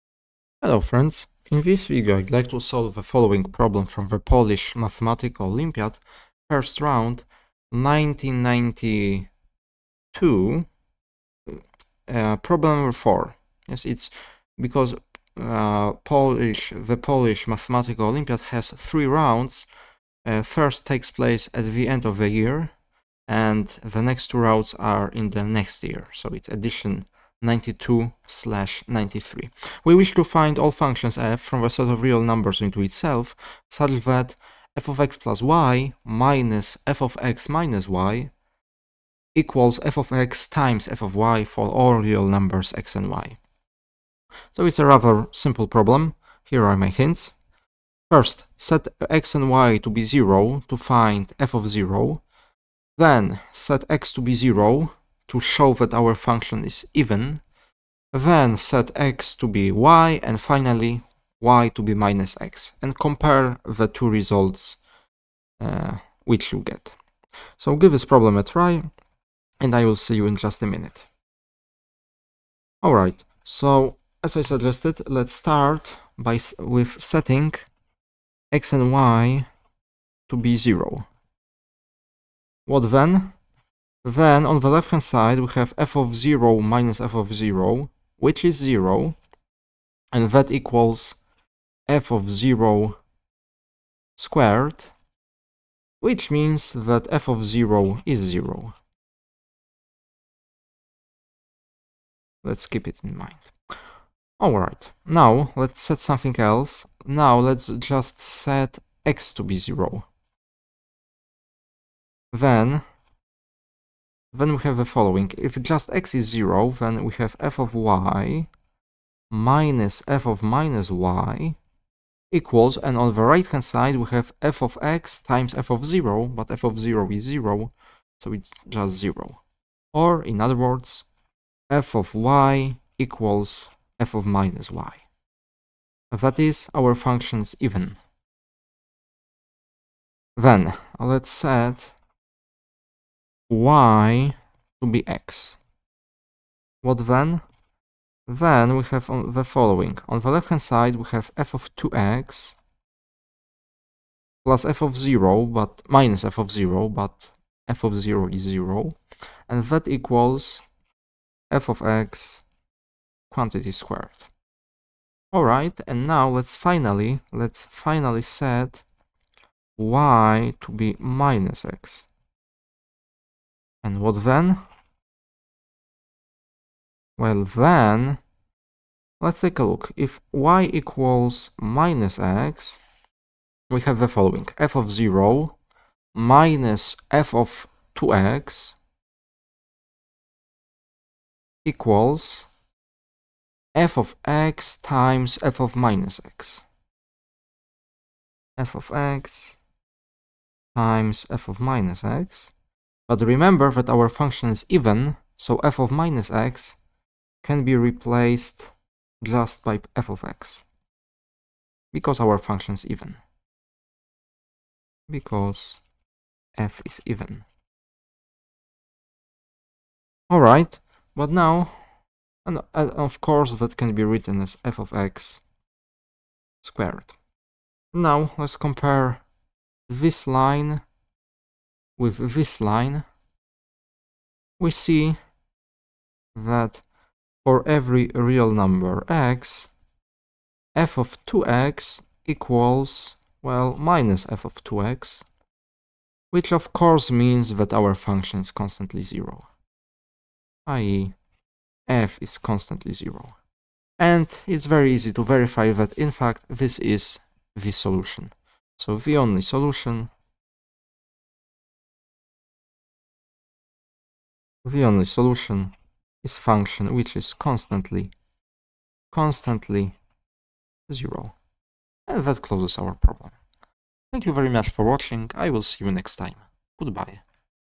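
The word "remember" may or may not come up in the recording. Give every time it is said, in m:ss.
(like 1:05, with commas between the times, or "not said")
3:23.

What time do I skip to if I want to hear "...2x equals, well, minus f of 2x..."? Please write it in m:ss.
4:01.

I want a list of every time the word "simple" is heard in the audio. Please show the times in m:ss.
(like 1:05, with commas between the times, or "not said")
0:45.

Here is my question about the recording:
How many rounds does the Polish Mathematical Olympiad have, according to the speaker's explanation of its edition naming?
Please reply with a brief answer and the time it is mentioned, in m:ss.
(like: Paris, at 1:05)
3, at 0:18.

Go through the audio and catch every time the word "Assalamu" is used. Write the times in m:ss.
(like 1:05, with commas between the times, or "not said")
not said.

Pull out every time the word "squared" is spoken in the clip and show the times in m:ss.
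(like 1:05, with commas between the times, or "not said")
1:34, 2:43, 3:46.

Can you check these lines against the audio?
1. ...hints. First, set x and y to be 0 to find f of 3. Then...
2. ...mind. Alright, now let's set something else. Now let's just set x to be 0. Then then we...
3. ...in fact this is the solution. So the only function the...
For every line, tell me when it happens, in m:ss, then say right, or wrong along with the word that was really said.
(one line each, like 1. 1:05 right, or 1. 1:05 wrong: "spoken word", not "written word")
1. 0:46 wrong: "0", not "3"
2. 1:43 right
3. 4:16 wrong: "solution", not "function".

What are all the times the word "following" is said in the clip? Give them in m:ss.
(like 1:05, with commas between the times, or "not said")
0:03, 1:54, 2:29, 3:04.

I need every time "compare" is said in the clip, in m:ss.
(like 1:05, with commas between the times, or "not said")
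1:02, 3:48.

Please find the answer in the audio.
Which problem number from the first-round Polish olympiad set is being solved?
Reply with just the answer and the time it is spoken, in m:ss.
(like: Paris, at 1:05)
4, at 0:12.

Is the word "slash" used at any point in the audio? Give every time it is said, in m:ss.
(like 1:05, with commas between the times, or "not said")
0:28.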